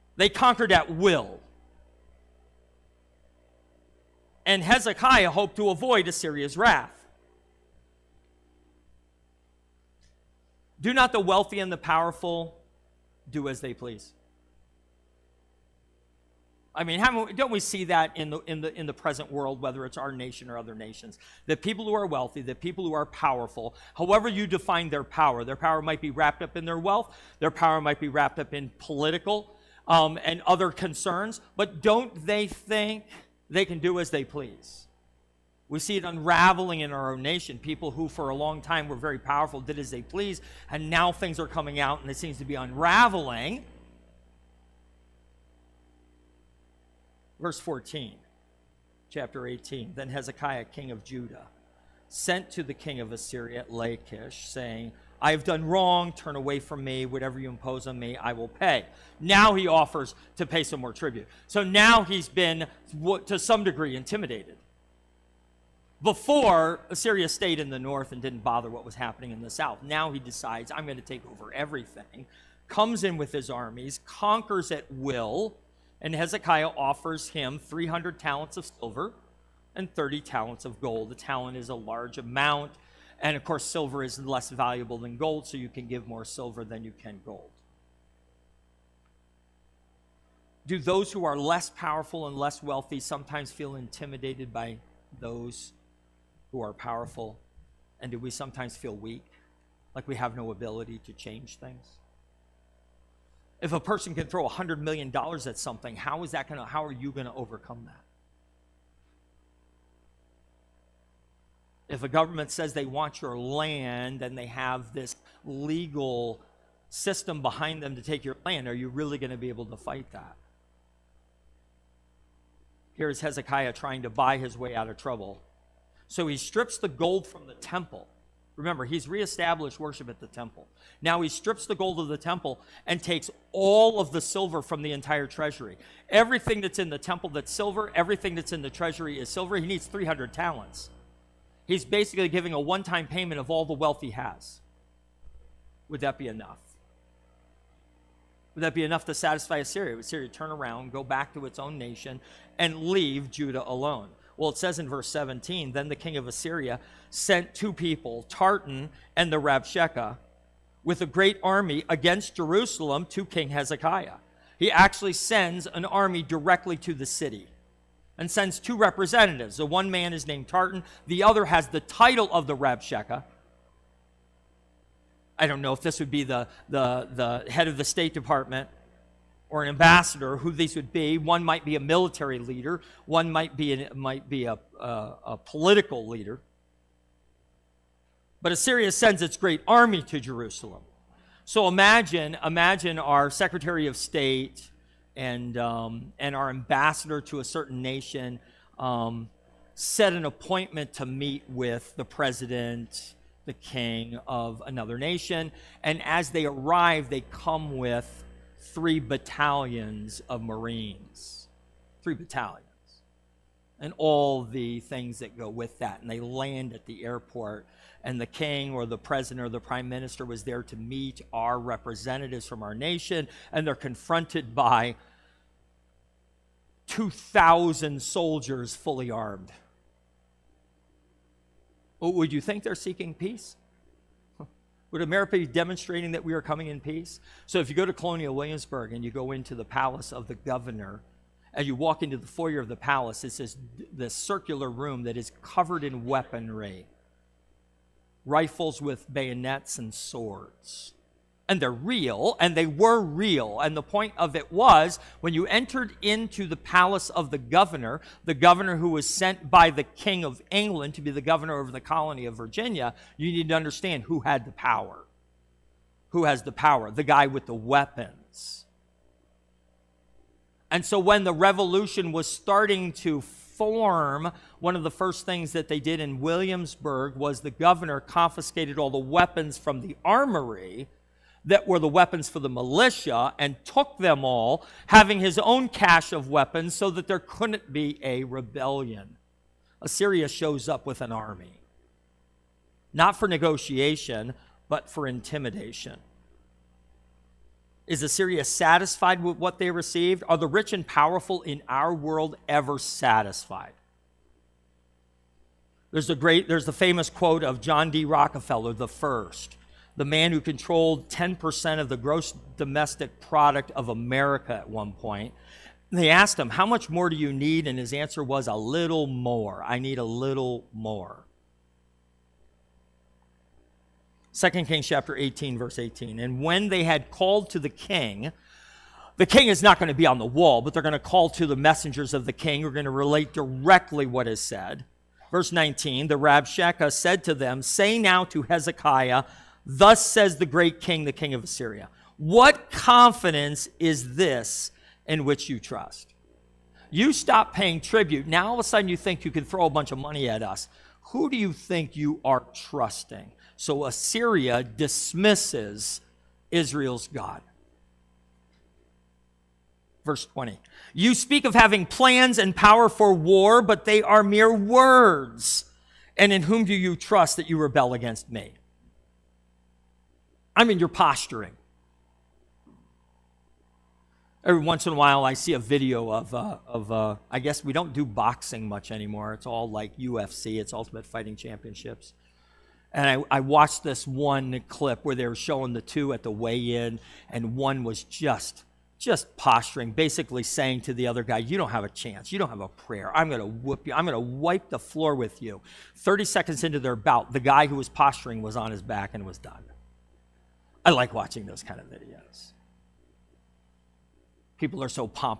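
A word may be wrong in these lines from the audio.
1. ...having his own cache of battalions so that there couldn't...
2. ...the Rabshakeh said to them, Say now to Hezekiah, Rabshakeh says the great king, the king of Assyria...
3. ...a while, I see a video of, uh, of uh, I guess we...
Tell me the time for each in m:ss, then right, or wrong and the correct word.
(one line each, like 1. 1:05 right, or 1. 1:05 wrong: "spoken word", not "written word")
1. 4:44 wrong: "weapons", not "battalions"
2. 5:36 wrong: "Thus", not "Rabshakeh"
3. 6:14 right.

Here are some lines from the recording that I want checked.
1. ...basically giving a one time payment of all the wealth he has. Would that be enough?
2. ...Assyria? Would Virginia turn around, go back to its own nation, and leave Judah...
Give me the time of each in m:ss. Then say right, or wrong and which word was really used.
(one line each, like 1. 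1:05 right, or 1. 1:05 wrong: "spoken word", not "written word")
1. 2:21 right
2. 2:29 wrong: "Assyria", not "Virginia".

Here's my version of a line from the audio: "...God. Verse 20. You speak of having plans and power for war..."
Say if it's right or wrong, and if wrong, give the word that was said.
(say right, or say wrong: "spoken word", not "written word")
right.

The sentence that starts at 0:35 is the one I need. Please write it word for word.
We see it unraveling in our own nation.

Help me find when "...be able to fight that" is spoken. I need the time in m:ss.
1:59.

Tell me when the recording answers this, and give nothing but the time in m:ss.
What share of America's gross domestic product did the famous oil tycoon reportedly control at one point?
5:11.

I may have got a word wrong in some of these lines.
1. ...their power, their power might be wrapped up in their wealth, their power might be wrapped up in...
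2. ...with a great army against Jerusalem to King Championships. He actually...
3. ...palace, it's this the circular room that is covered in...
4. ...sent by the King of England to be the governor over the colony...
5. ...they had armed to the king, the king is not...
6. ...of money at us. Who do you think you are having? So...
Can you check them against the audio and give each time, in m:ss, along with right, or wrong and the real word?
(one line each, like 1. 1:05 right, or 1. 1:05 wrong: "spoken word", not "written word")
1. 0:24 right
2. 2:40 wrong: "Hezekiah", not "Championships"
3. 4:02 right
4. 4:19 right
5. 5:26 wrong: "called", not "armed"
6. 5:49 wrong: "trusting", not "having".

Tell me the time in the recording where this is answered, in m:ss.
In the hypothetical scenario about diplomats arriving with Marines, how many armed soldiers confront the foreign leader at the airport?
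3:46.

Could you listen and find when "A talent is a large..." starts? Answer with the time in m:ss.
1:21.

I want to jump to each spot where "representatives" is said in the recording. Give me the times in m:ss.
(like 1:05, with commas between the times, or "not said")
2:48, 3:41.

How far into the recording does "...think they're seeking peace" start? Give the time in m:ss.
3:52.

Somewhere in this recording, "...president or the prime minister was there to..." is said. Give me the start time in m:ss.
3:38.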